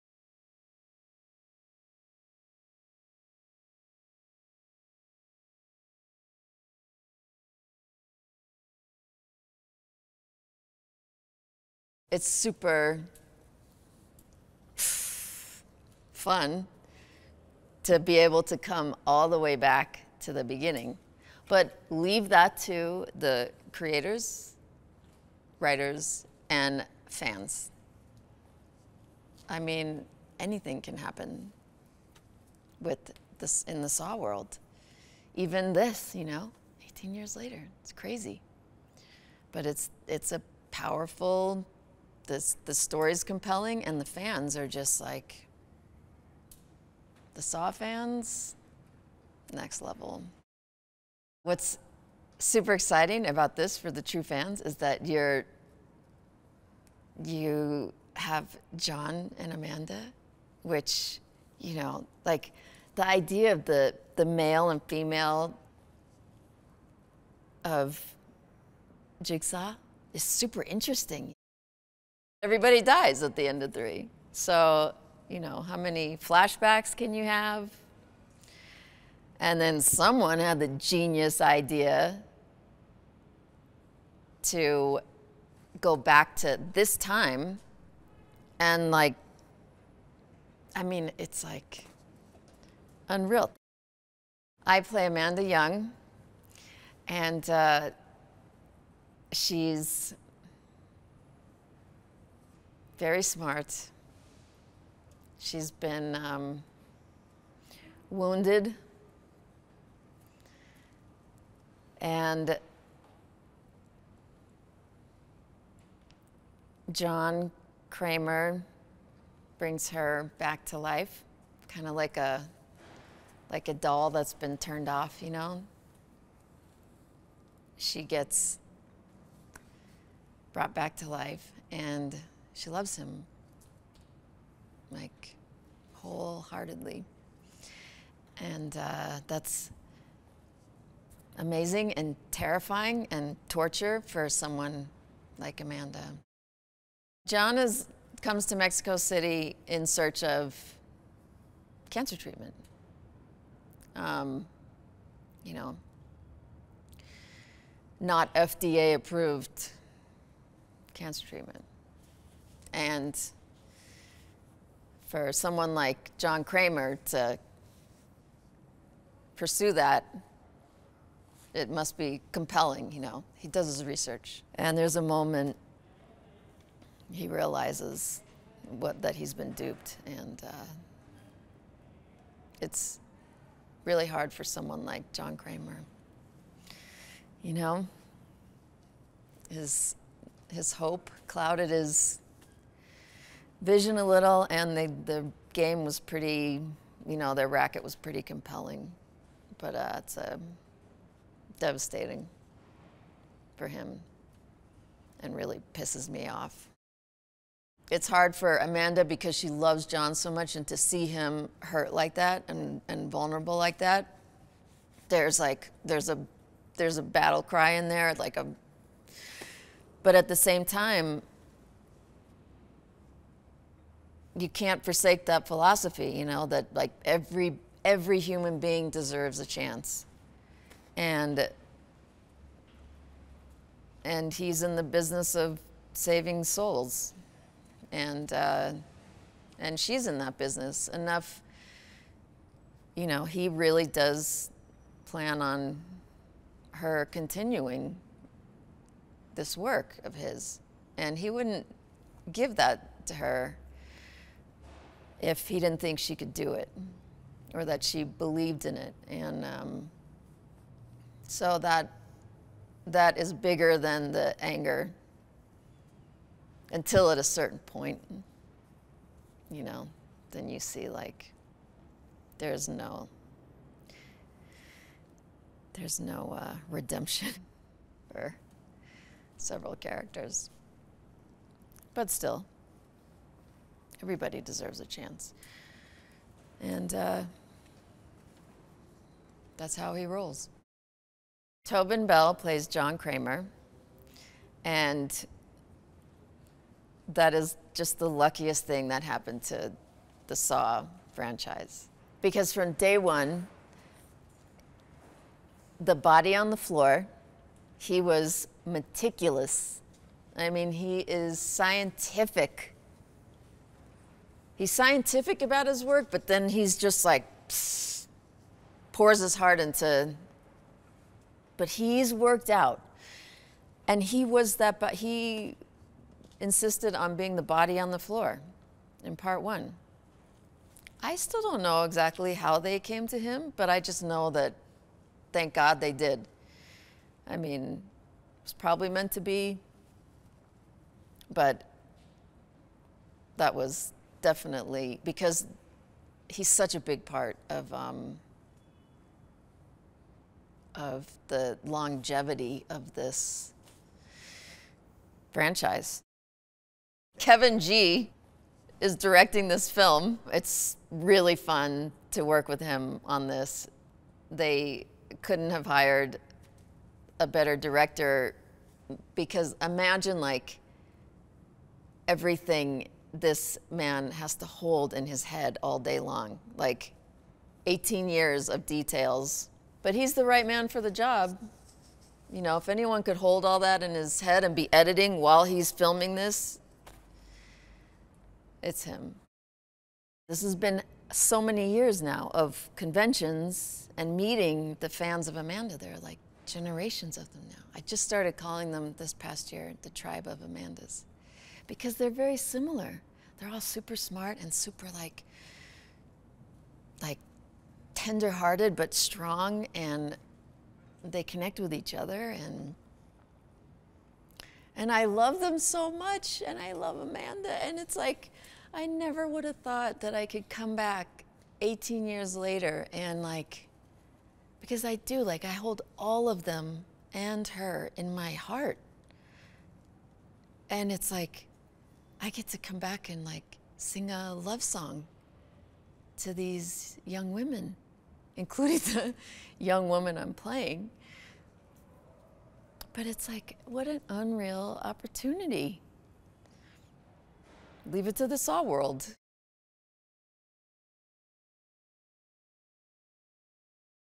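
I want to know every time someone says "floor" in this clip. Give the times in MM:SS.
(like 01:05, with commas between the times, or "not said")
05:06, 05:27.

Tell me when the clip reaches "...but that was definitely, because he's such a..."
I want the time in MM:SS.
05:41.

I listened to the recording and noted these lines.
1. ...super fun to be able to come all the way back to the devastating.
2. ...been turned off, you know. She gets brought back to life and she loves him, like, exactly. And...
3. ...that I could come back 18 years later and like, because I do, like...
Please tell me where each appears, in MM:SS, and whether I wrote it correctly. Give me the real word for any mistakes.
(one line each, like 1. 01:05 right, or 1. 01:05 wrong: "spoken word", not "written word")
1. 00:12 wrong: "beginning", not "devastating"
2. 02:04 wrong: "wholeheartedly", not "exactly"
3. 07:00 right.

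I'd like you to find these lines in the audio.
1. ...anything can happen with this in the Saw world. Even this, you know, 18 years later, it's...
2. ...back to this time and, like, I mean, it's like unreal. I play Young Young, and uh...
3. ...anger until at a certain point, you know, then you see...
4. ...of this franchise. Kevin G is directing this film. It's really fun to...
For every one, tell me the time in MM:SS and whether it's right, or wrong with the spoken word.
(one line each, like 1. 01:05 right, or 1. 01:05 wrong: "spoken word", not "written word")
1. 00:30 right
2. 01:25 wrong: "Amanda", not "Young"
3. 04:24 right
4. 05:52 right.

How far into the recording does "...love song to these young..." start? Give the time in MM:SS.
07:14.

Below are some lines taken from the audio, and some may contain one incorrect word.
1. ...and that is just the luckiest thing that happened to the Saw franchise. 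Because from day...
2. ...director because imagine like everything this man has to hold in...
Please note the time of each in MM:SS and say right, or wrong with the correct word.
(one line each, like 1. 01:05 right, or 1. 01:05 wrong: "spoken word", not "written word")
1. 04:54 right
2. 06:07 right.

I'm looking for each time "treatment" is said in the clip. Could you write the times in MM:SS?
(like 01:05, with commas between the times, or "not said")
02:32, 02:41.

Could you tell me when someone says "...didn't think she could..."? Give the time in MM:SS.
04:15.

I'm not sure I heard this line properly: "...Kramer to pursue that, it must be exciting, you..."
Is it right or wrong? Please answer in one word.
wrong.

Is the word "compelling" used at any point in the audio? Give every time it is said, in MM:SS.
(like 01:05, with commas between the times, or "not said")
00:43, 02:52, 03:18.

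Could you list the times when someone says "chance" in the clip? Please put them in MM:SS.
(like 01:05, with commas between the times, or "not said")
03:49, 04:44.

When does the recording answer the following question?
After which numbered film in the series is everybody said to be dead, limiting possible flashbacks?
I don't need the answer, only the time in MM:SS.
01:13.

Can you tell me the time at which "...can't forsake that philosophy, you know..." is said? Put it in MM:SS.
03:44.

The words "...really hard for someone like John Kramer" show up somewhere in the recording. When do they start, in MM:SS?
03:03.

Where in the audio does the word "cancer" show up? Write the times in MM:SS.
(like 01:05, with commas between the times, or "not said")
02:31, 02:40.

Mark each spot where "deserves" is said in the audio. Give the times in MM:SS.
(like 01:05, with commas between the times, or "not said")
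03:48, 04:44.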